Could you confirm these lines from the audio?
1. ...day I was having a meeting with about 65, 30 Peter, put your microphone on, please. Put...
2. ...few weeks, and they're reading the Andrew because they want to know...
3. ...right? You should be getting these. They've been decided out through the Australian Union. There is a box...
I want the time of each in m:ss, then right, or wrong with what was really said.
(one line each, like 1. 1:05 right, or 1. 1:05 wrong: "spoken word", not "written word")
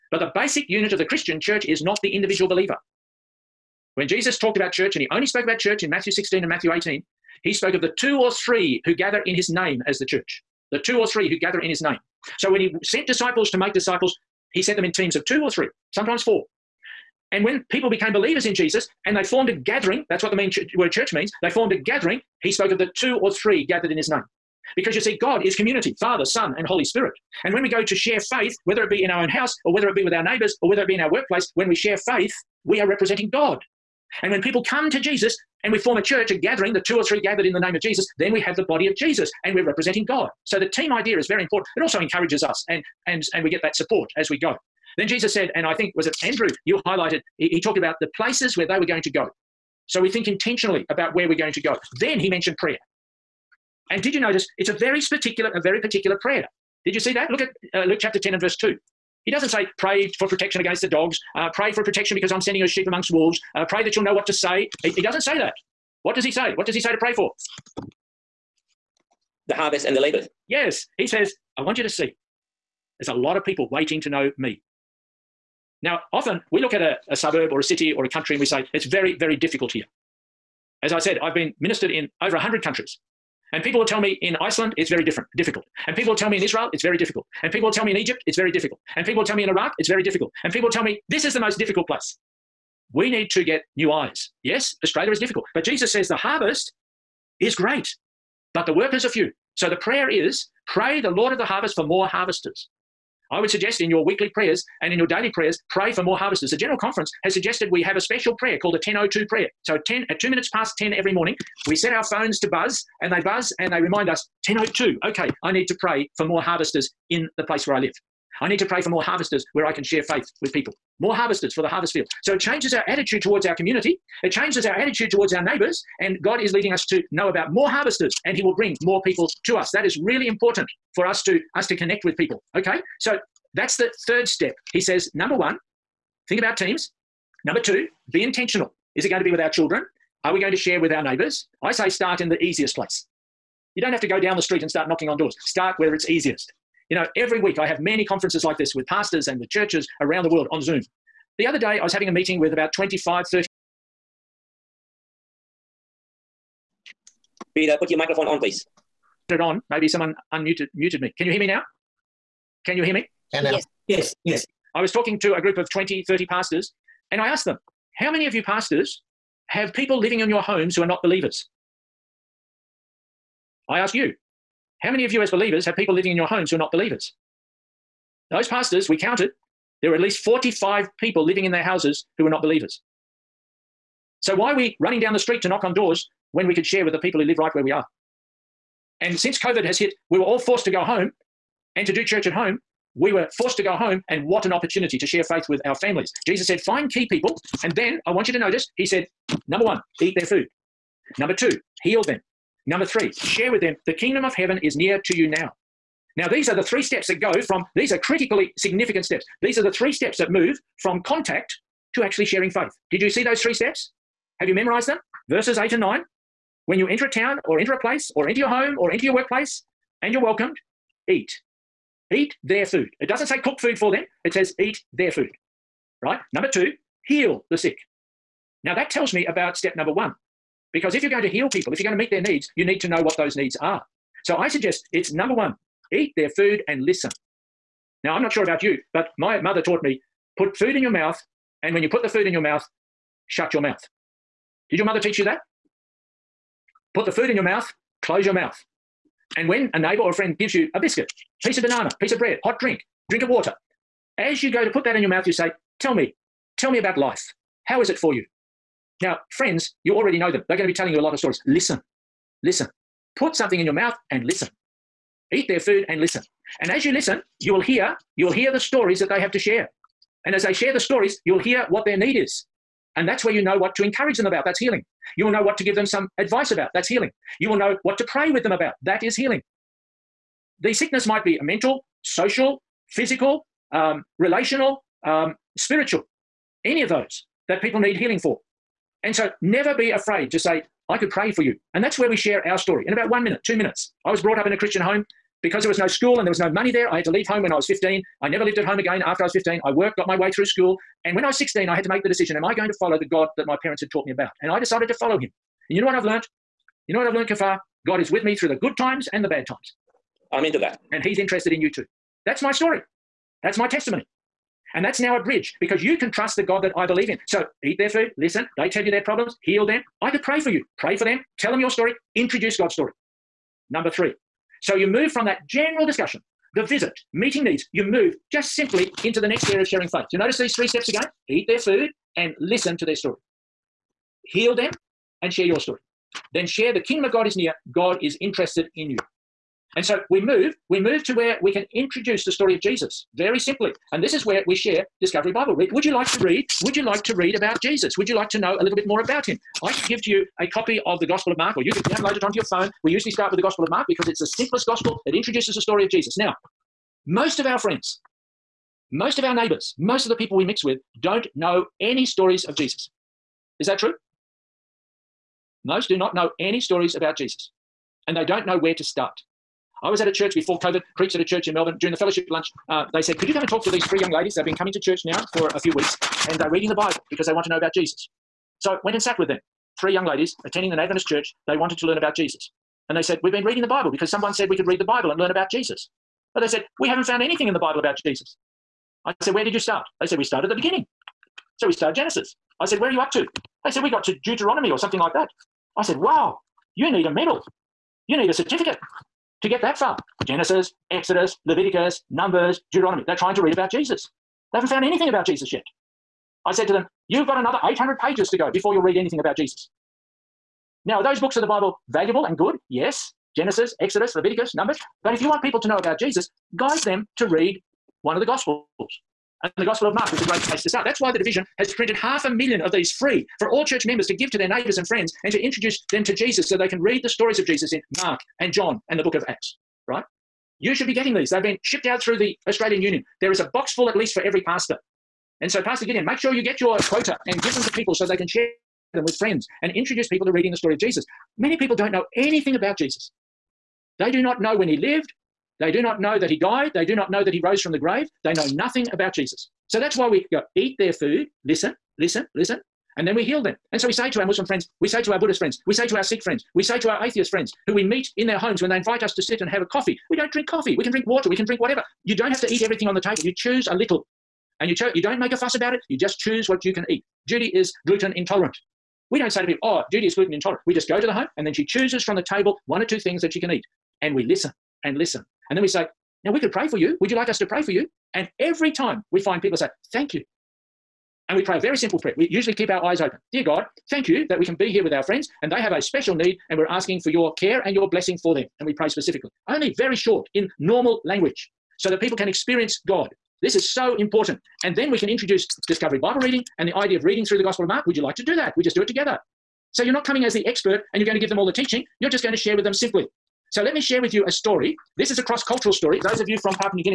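1. 2:31 wrong: "25", not "65"
2. 6:15 wrong: "Bible", not "Andrew"
3. 7:09 wrong: "shipped", not "decided".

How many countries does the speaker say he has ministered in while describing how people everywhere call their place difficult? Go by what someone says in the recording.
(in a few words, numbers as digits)
over 100.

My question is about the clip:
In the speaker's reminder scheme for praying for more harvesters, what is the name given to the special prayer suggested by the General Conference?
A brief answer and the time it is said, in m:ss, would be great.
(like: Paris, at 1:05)
1002 prayer, at 1:48.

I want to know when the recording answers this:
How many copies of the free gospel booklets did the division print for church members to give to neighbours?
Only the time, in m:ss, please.
7:01.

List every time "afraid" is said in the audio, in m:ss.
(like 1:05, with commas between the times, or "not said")
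4:49.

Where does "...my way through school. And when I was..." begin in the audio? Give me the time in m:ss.
5:00.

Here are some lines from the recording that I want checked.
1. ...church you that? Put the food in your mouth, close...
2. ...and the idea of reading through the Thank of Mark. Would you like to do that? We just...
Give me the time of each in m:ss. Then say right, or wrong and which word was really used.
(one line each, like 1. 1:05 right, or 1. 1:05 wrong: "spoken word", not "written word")
1. 4:04 wrong: "teach", not "church"
2. 8:16 wrong: "Gospel", not "Thank".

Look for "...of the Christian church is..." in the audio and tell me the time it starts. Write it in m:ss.
0:00.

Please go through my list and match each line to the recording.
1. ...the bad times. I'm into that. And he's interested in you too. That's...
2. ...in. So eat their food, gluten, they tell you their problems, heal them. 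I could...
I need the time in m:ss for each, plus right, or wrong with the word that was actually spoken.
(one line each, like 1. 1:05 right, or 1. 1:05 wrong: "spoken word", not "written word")
1. 5:09 right
2. 5:17 wrong: "listen", not "gluten".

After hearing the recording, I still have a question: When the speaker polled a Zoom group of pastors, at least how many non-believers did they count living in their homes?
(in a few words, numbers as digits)
45.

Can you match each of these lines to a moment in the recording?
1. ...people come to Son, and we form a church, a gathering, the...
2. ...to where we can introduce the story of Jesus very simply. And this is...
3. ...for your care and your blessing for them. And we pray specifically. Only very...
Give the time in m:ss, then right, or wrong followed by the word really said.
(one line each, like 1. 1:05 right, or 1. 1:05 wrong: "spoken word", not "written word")
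1. 0:34 wrong: "Jesus", not "Son"
2. 5:41 right
3. 8:06 right.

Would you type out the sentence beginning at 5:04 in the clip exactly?
And I decided to follow him.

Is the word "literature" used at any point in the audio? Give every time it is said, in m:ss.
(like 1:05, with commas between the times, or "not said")
not said.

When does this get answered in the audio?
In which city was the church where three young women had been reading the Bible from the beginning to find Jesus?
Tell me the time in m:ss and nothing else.
6:11.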